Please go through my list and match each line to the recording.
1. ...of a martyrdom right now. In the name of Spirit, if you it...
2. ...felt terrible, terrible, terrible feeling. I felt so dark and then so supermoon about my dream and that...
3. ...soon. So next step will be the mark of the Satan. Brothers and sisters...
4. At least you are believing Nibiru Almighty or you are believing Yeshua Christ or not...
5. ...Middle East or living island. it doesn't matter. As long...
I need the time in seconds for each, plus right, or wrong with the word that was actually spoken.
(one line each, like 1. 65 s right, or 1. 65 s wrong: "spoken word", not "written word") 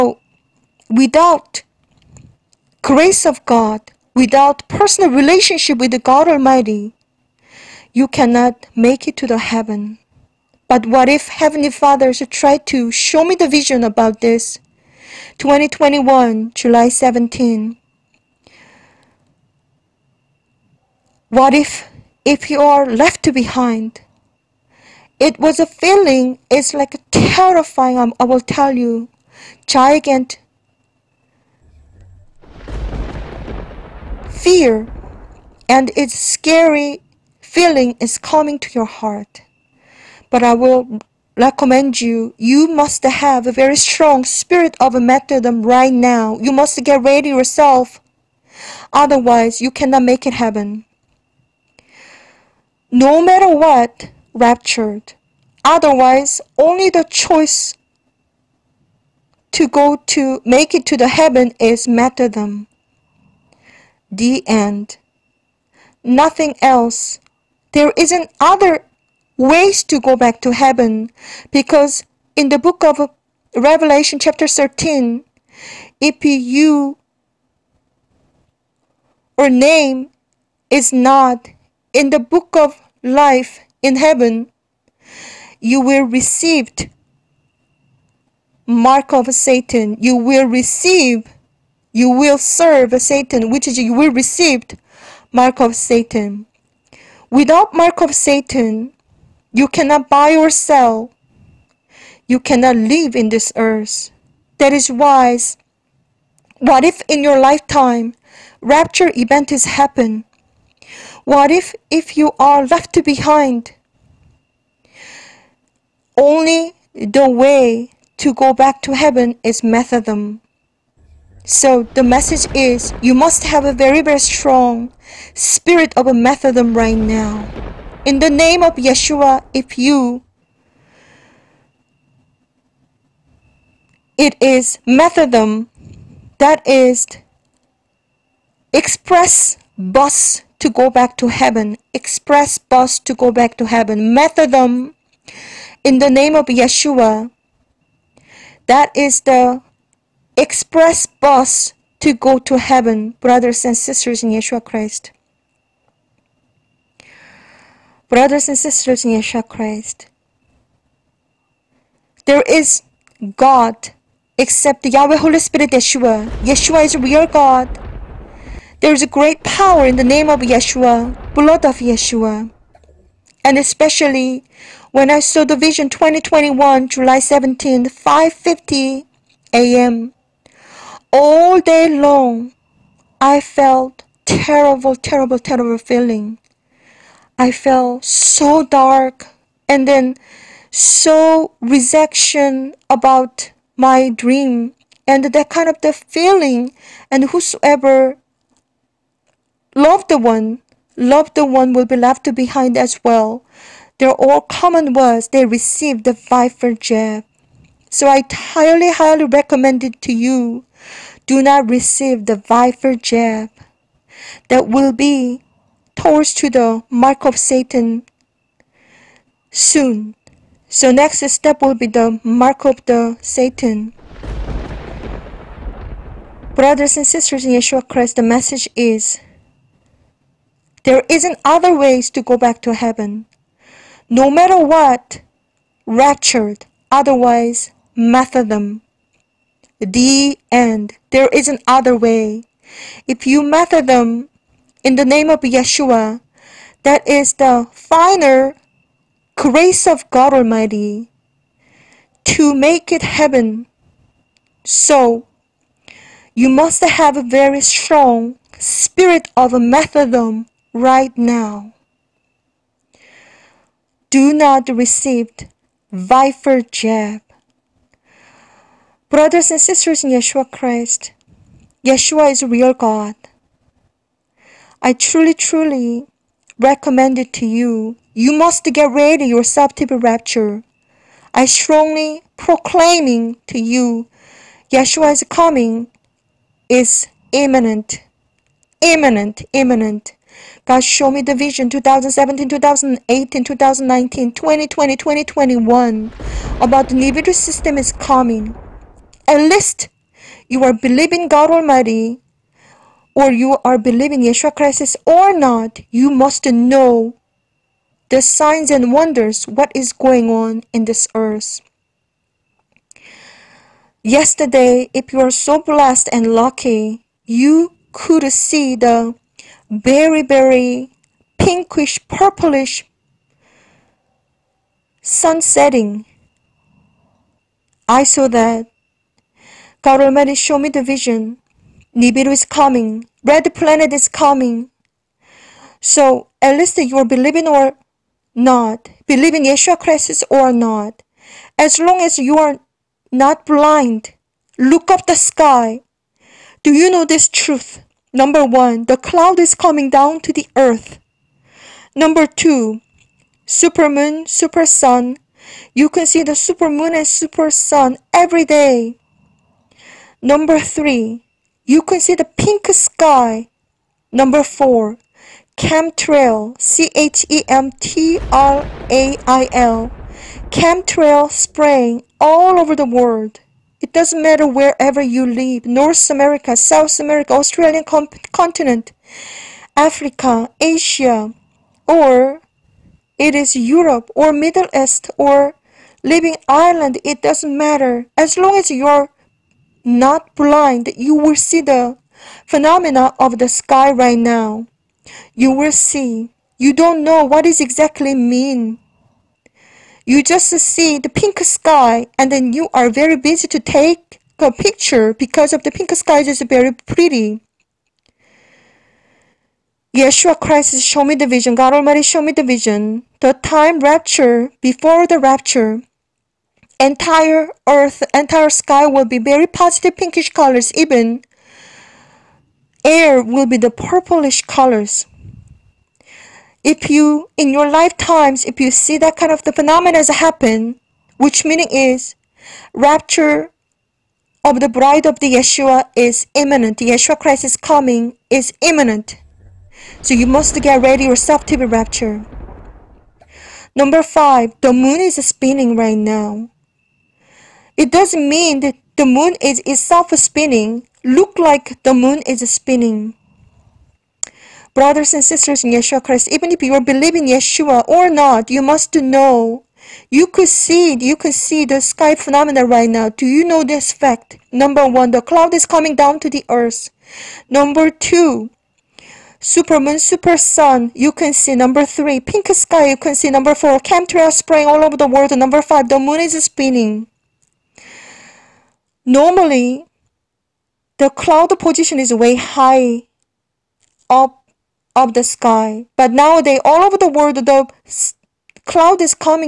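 1. 125 s wrong: "Yeshua", not "Spirit"
2. 183 s wrong: "rejection", not "supermoon"
3. 219 s right
4. 299 s wrong: "God", not "Nibiru"
5. 384 s right.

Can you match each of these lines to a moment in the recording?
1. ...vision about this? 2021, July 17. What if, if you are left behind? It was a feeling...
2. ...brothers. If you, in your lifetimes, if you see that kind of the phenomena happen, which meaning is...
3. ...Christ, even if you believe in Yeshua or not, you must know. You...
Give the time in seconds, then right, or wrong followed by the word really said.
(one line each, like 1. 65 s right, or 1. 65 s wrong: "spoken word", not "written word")
1. 13 s right
2. 424 s wrong: "colors", not "brothers"
3. 456 s right.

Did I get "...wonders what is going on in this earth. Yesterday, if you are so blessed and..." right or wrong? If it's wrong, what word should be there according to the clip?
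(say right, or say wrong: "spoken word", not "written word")
right.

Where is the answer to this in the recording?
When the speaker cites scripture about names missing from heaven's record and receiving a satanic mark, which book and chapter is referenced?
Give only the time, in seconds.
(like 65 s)
73 s.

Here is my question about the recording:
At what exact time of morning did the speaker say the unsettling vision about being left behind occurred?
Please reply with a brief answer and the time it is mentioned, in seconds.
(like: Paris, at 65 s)
5:50 a.m., at 177 s.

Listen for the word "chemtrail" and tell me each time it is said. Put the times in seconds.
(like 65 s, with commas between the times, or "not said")
365 s, 370 s, 473 s.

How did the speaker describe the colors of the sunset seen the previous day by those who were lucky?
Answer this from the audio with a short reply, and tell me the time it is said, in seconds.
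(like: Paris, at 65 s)
Pinkish, purplish, at 321 s.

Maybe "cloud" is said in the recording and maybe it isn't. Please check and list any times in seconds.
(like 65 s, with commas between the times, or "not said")
348 s, 465 s, 481 s, 488 s.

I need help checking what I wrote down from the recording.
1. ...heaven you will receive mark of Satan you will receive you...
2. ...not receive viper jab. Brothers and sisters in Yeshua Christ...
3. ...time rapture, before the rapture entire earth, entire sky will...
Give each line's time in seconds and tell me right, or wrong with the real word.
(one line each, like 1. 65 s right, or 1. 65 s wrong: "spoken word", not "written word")
1. 83 s right
2. 264 s right
3. 413 s right.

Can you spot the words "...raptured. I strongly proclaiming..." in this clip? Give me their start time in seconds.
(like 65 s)
279 s.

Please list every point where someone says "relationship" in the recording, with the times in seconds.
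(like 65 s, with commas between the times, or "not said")
5 s.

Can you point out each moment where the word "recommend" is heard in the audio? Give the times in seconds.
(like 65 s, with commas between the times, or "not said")
41 s, 209 s, 276 s.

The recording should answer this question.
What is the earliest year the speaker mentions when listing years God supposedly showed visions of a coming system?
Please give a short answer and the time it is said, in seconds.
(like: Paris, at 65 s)
2017, at 291 s.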